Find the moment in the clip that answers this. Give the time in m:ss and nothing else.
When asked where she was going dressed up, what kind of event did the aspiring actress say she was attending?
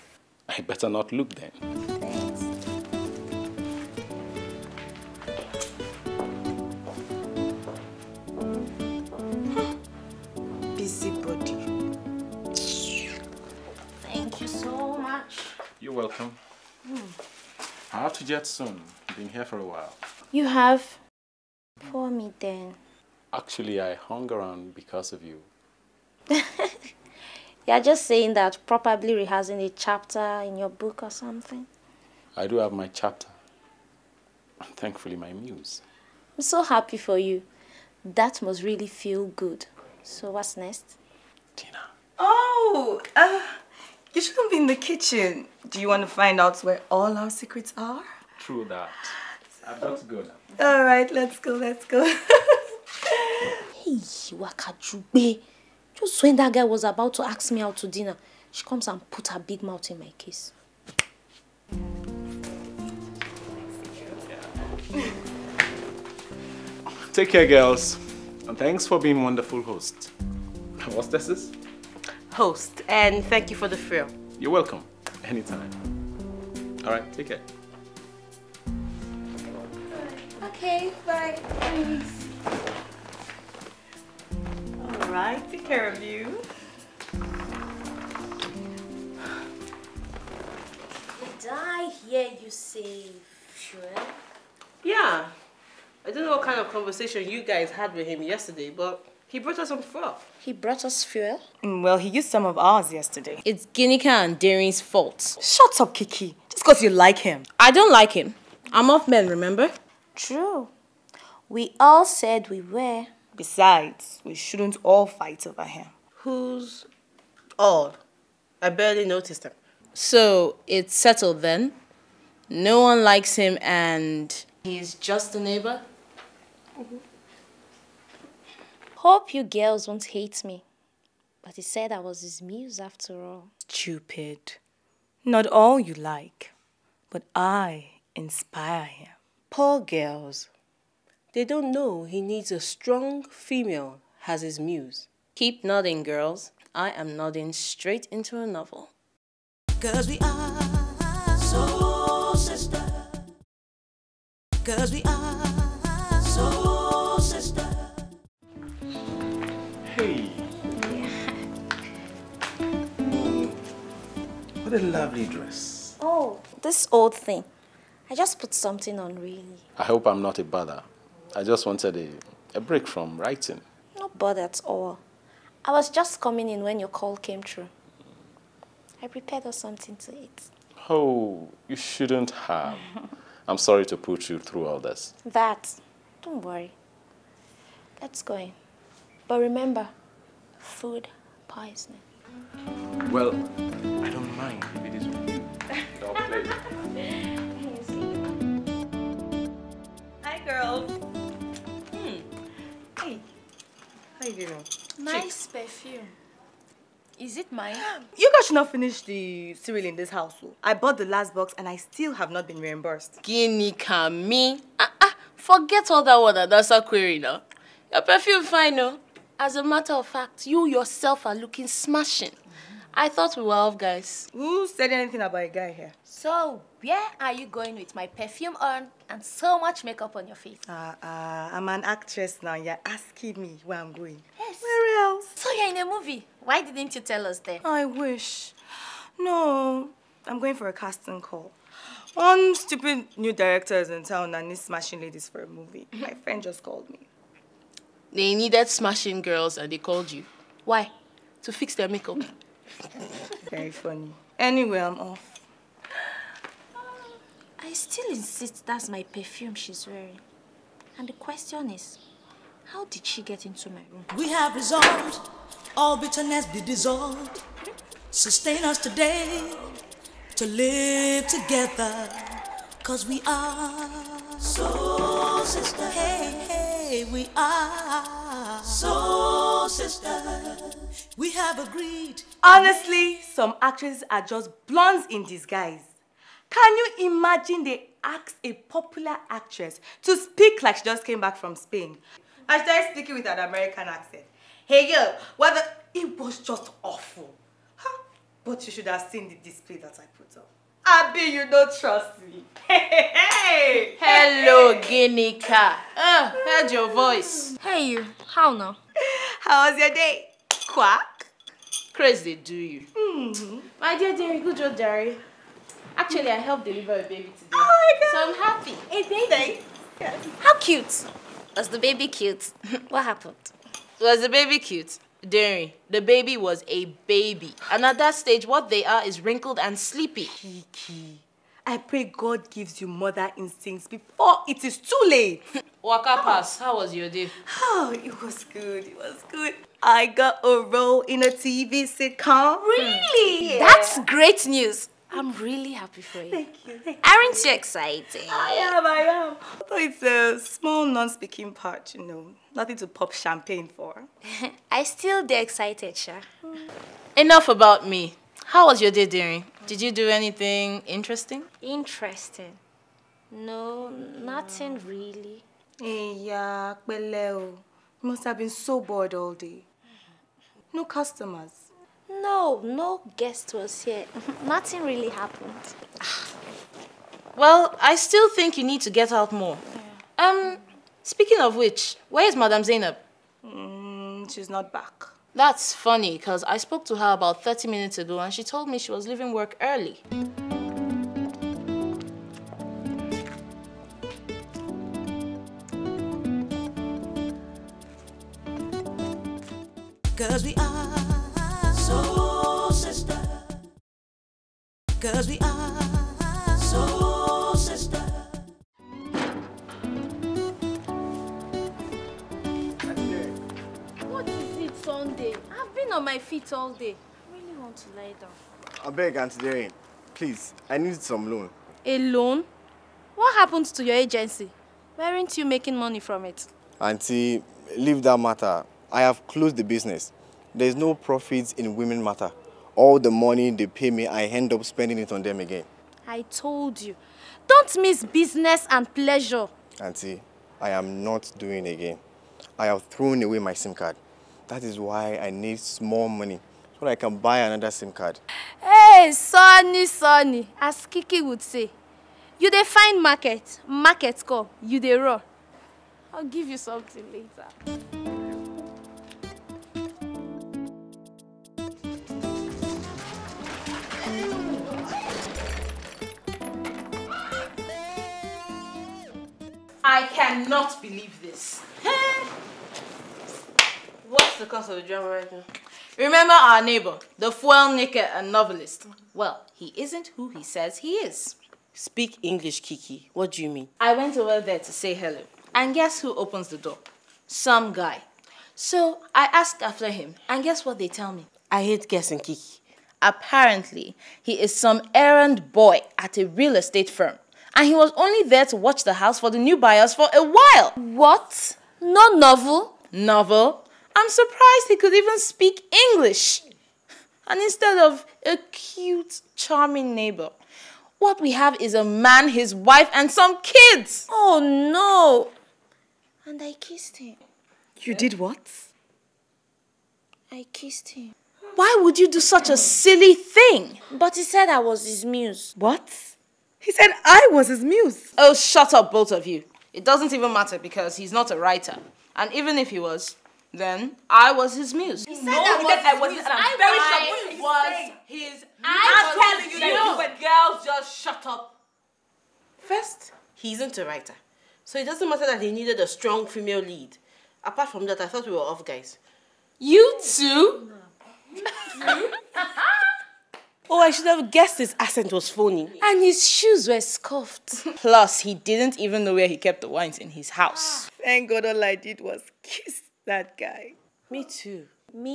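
4:00.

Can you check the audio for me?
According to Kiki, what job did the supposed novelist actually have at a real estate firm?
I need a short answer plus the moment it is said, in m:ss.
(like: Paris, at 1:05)
Errand boy, at 8:14.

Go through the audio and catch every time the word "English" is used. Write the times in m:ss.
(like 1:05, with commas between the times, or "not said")
8:02, 8:25.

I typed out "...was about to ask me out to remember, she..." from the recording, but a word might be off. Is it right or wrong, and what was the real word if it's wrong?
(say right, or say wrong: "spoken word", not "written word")
wrong: "dinner", not "remember".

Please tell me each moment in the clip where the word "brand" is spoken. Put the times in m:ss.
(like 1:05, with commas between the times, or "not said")
not said.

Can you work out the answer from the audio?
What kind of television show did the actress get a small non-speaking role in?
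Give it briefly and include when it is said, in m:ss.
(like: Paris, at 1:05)
A TV sitcom, at 5:41.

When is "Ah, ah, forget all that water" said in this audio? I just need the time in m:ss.
3:34.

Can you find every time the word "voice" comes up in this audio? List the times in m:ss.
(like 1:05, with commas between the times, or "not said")
5:06.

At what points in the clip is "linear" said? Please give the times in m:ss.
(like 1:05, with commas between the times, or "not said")
not said.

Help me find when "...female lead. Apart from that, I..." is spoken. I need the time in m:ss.
9:06.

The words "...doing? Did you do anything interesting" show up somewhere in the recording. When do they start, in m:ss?
5:59.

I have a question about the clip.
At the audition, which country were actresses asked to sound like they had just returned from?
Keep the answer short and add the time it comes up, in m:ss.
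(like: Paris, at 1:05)
Spain, at 4:51.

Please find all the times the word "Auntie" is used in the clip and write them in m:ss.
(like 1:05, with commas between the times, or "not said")
6:59, 7:06, 7:19.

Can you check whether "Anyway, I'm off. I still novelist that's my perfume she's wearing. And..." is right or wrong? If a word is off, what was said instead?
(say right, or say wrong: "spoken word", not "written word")
wrong: "insist", not "novelist".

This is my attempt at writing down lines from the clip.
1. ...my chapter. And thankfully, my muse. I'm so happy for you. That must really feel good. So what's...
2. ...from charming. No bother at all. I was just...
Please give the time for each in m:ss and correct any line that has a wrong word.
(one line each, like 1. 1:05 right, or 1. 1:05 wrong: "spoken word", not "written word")
1. 0:32 right
2. 2:52 wrong: "writing", not "charming".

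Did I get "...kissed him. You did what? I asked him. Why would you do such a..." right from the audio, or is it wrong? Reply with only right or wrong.
wrong.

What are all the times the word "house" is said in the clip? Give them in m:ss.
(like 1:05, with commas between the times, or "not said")
3:30, 8:18, 9:20.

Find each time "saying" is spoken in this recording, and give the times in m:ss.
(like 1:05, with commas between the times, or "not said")
0:28.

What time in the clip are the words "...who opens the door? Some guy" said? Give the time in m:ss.
8:05.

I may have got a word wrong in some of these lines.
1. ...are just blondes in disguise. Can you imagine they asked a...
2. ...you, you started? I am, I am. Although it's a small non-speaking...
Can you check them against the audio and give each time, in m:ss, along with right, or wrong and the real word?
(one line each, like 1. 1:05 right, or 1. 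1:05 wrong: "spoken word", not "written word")
1. 4:44 right
2. 5:47 wrong: "excited", not "started".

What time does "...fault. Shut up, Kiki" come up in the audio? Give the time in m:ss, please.
1:44.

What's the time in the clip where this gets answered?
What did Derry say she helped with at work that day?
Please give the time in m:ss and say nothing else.
5:16.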